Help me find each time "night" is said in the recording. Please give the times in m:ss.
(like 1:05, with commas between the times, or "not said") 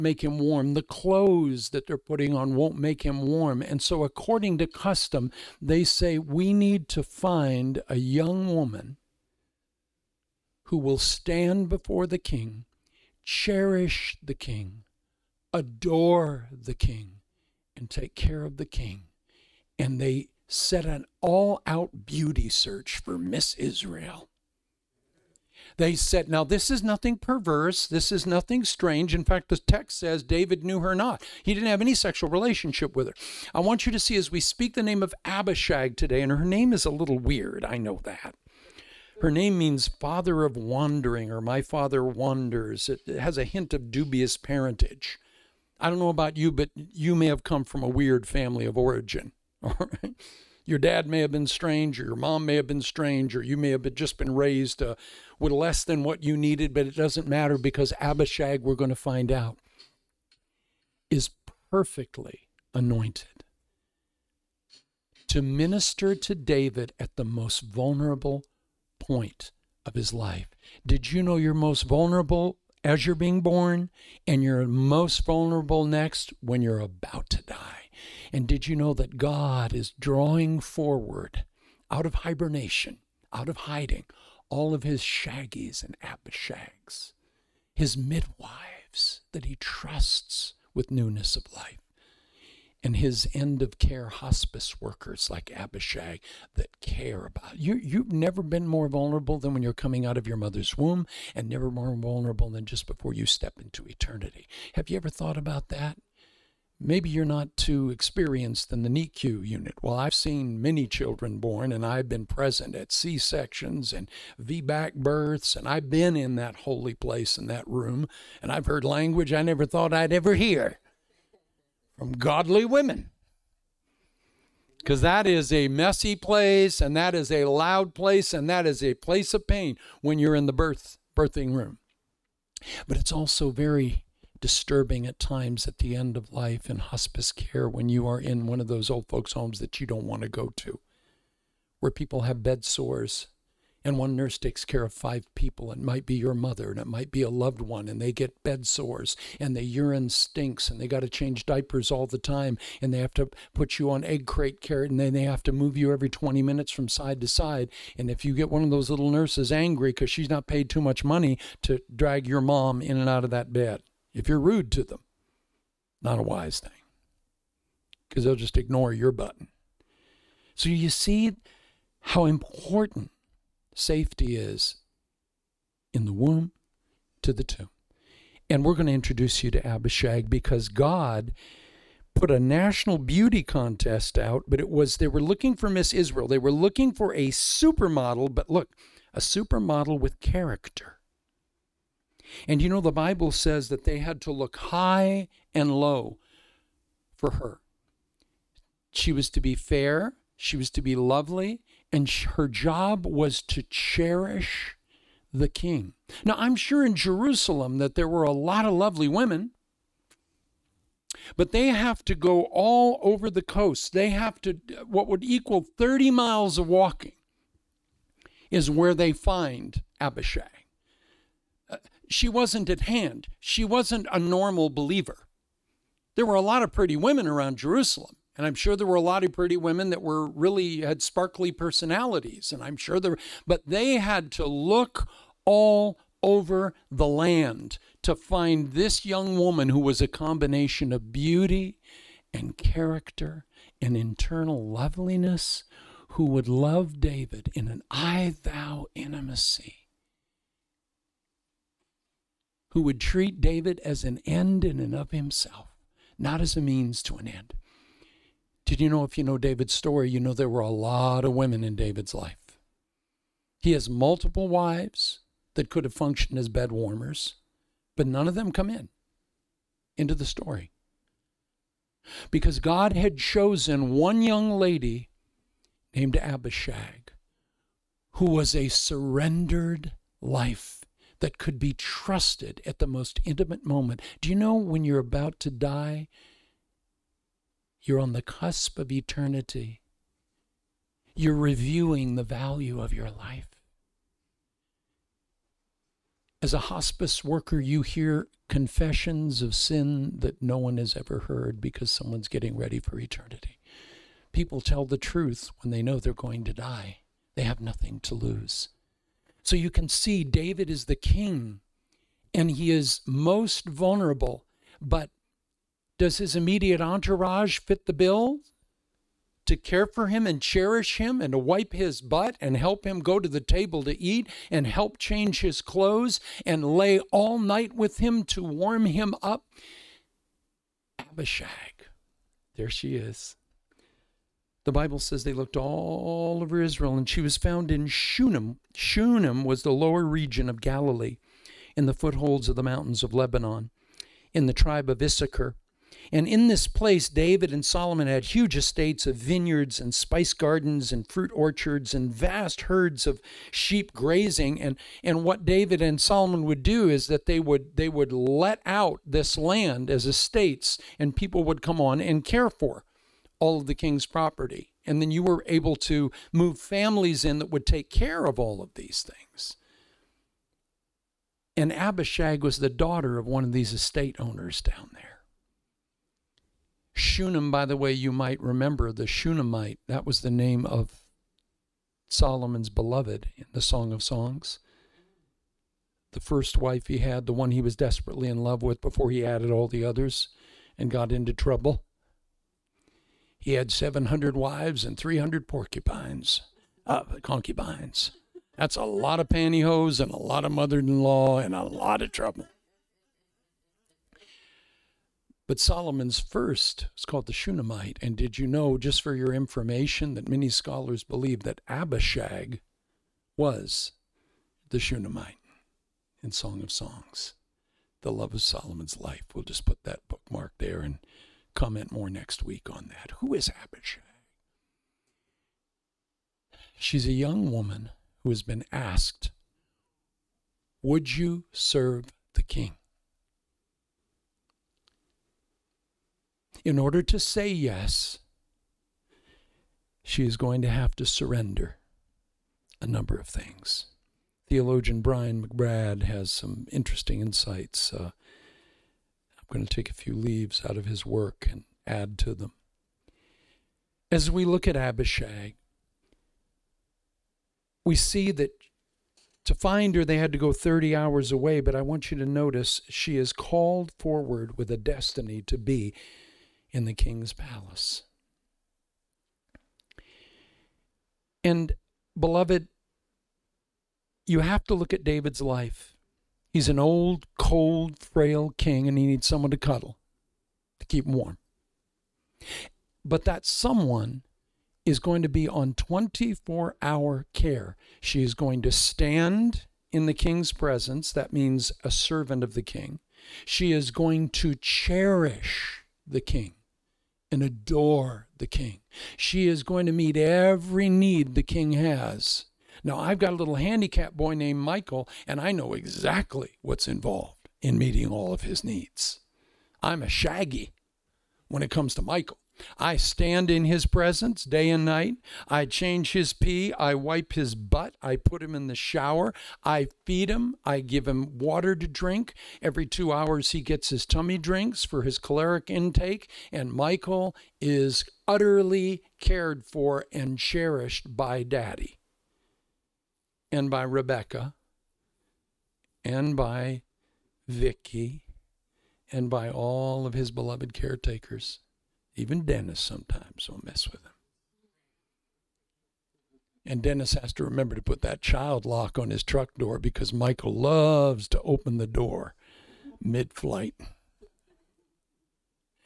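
5:27, 8:34.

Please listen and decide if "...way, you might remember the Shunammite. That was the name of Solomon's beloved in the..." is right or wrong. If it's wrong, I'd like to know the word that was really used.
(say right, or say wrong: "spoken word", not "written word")
right.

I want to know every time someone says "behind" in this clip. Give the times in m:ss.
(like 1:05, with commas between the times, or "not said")
not said.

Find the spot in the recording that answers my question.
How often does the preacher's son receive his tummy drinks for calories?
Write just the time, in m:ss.
8:42.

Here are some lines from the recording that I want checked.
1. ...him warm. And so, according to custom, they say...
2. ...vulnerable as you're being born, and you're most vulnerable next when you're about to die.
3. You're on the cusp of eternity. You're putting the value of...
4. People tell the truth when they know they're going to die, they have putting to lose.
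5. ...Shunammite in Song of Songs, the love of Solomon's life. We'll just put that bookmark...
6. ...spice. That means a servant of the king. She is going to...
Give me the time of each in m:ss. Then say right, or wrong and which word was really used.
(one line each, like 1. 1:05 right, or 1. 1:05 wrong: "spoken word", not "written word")
1. 0:03 right
2. 1:11 right
3. 4:47 wrong: "reviewing", not "putting"
4. 5:04 wrong: "nothing", not "putting"
5. 6:54 right
6. 8:10 wrong: "presence", not "spice".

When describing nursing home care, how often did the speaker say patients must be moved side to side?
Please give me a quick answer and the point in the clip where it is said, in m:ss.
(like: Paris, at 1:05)
Every 20 minutes, at 2:35.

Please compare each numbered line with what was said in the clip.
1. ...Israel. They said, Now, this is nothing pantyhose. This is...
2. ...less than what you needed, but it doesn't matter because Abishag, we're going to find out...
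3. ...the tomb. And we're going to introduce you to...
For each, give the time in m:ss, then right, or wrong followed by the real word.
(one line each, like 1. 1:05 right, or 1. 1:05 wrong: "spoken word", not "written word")
1. 0:23 wrong: "perverse", not "pantyhose"
2. 0:55 right
3. 2:57 right.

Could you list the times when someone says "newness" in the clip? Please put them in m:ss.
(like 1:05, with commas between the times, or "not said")
1:30.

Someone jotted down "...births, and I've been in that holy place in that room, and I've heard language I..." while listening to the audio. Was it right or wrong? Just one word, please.
right.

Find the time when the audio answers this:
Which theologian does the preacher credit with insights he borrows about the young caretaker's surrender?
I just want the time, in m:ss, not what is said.
7:25.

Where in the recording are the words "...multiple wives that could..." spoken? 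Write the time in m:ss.
4:23.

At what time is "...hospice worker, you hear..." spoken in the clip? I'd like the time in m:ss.
4:56.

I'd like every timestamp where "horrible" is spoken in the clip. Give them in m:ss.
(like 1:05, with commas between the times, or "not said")
not said.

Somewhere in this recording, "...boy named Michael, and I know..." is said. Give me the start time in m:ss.
8:24.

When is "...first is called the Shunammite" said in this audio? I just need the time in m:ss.
6:46.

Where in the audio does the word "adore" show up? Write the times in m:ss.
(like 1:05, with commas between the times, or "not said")
0:15, 8:17.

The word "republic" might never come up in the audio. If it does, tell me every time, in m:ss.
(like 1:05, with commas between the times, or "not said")
not said.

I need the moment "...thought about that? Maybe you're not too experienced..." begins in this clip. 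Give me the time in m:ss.
1:45.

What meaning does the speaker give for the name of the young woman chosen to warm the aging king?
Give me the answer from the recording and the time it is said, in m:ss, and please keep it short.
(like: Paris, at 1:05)
Father of wandering, at 0:39.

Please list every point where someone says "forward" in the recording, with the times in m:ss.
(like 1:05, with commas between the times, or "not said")
1:20, 7:43.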